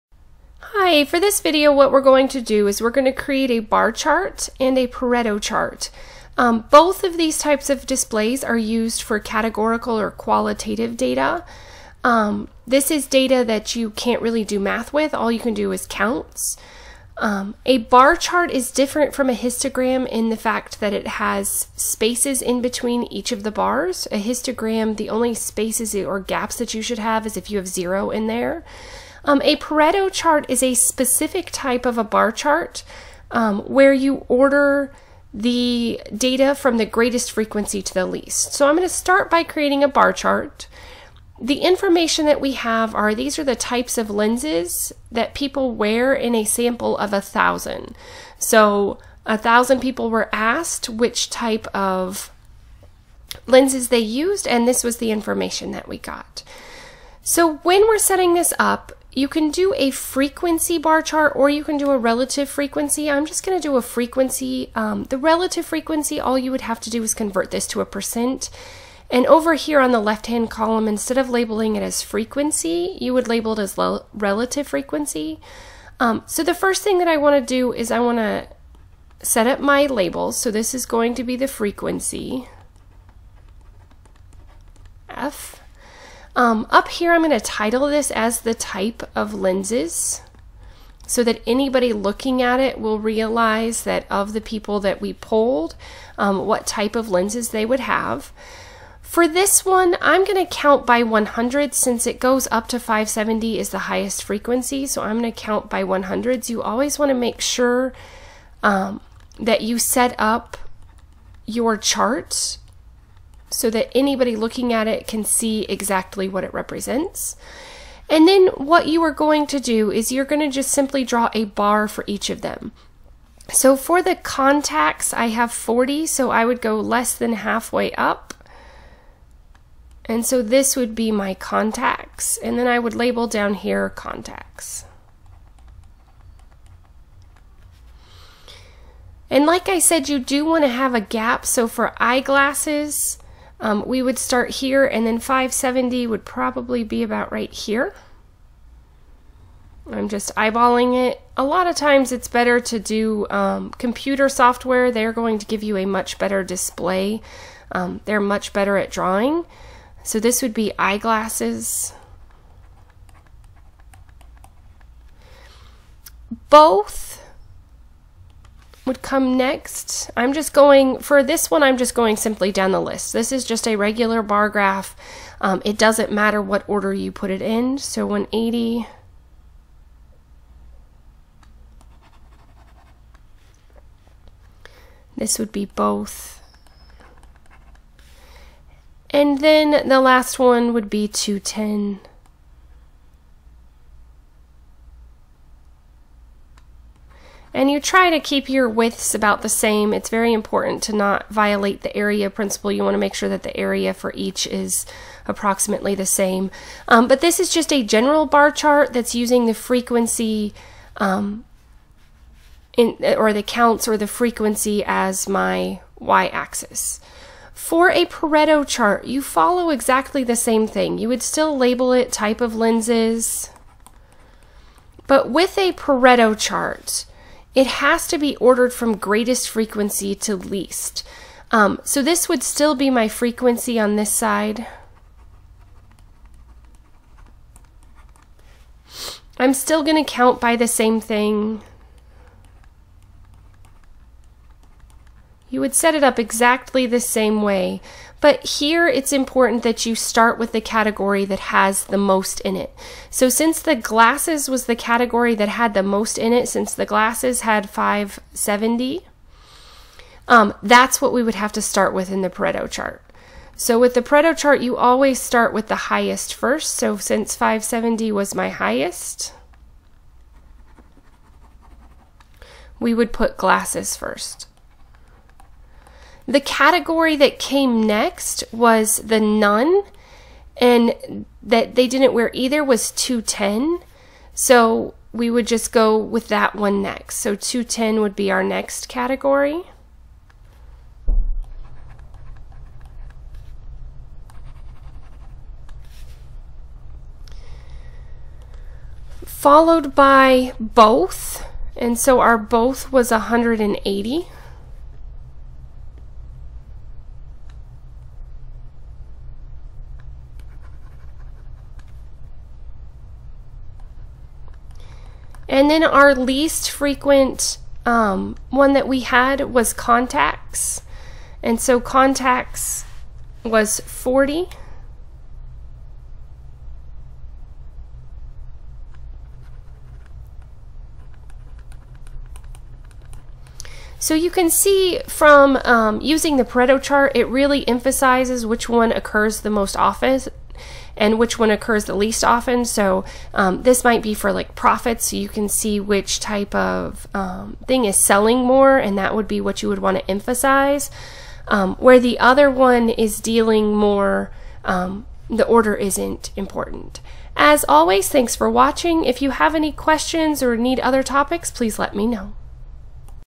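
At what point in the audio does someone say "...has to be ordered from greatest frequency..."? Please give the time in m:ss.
3:47.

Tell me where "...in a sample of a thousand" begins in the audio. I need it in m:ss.
0:46.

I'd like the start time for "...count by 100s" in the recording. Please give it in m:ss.
1:45.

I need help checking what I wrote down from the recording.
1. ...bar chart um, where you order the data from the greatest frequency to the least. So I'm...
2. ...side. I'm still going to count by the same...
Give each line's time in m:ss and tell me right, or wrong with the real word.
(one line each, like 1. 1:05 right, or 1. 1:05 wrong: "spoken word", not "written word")
1. 0:32 right
2. 3:54 right.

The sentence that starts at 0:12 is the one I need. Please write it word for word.
Um, this is data that you can't really do math with, all you can do is counts.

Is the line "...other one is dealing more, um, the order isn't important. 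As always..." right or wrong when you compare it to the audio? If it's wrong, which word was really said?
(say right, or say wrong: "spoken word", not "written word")
right.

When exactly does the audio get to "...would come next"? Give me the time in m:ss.
2:48.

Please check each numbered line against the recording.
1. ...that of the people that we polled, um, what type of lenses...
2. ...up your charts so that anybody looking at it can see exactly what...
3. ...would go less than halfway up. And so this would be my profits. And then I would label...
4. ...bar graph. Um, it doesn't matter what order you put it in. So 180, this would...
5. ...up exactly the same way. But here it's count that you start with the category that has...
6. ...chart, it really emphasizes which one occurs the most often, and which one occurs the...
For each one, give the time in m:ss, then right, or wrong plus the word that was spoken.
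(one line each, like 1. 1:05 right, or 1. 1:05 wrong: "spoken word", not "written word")
1. 1:33 right
2. 1:50 right
3. 2:06 wrong: "contacts", not "profits"
4. 2:54 right
5. 4:06 wrong: "important", not "count"
6. 5:36 right.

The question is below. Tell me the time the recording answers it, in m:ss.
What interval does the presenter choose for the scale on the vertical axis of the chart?
1:40.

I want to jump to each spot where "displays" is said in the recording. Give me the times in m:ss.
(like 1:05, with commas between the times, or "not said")
0:07, 2:36.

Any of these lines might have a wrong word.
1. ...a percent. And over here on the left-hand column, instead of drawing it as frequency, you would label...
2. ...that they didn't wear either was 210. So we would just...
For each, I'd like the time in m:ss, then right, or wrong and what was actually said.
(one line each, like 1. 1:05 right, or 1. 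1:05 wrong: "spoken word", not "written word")
1. 1:07 wrong: "labeling", not "drawing"
2. 4:41 right.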